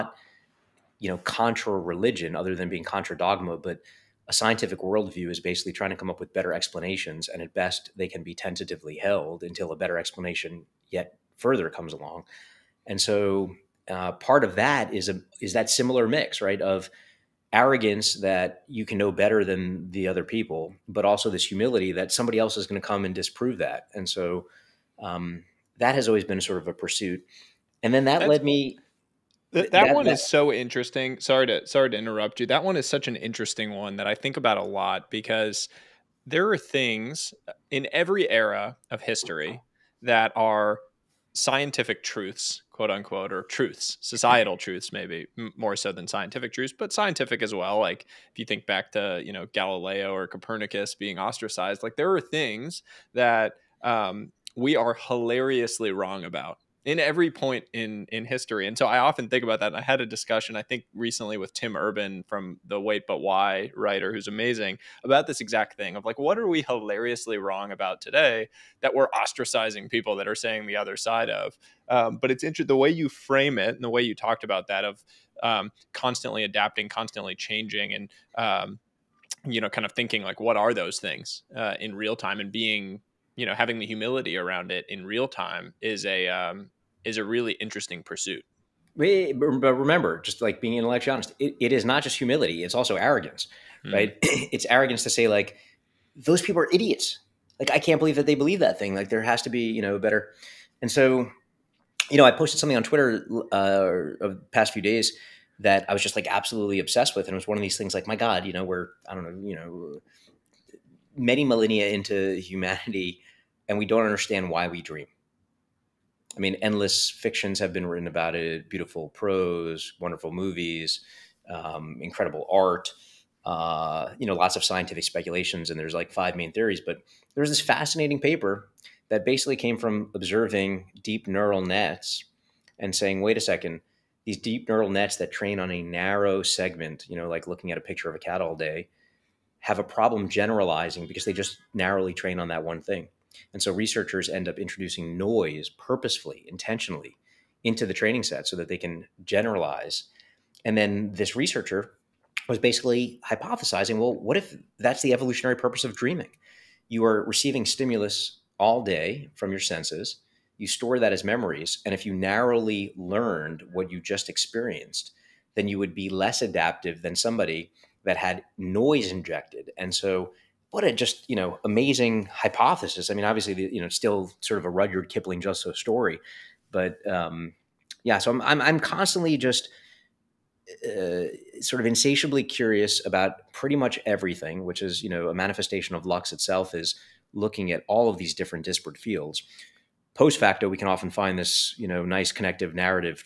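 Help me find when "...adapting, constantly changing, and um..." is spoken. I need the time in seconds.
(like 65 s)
76 s.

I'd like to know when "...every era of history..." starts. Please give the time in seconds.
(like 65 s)
37 s.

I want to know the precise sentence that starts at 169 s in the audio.
And so what a just you know amazing hypothesis.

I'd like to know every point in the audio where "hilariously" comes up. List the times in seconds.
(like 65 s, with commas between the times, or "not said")
54 s, 66 s.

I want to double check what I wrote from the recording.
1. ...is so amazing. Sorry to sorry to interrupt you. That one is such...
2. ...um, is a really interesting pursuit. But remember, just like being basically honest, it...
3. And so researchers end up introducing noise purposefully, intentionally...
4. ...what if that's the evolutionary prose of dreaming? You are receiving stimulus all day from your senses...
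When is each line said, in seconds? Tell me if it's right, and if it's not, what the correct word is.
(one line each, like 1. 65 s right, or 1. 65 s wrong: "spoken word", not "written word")
1. 30 s wrong: "interesting", not "amazing"
2. 86 s wrong: "intellectually", not "basically"
3. 143 s right
4. 154 s wrong: "purpose", not "prose".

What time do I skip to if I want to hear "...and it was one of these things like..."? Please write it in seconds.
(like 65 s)
107 s.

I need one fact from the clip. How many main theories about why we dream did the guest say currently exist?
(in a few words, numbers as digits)
5.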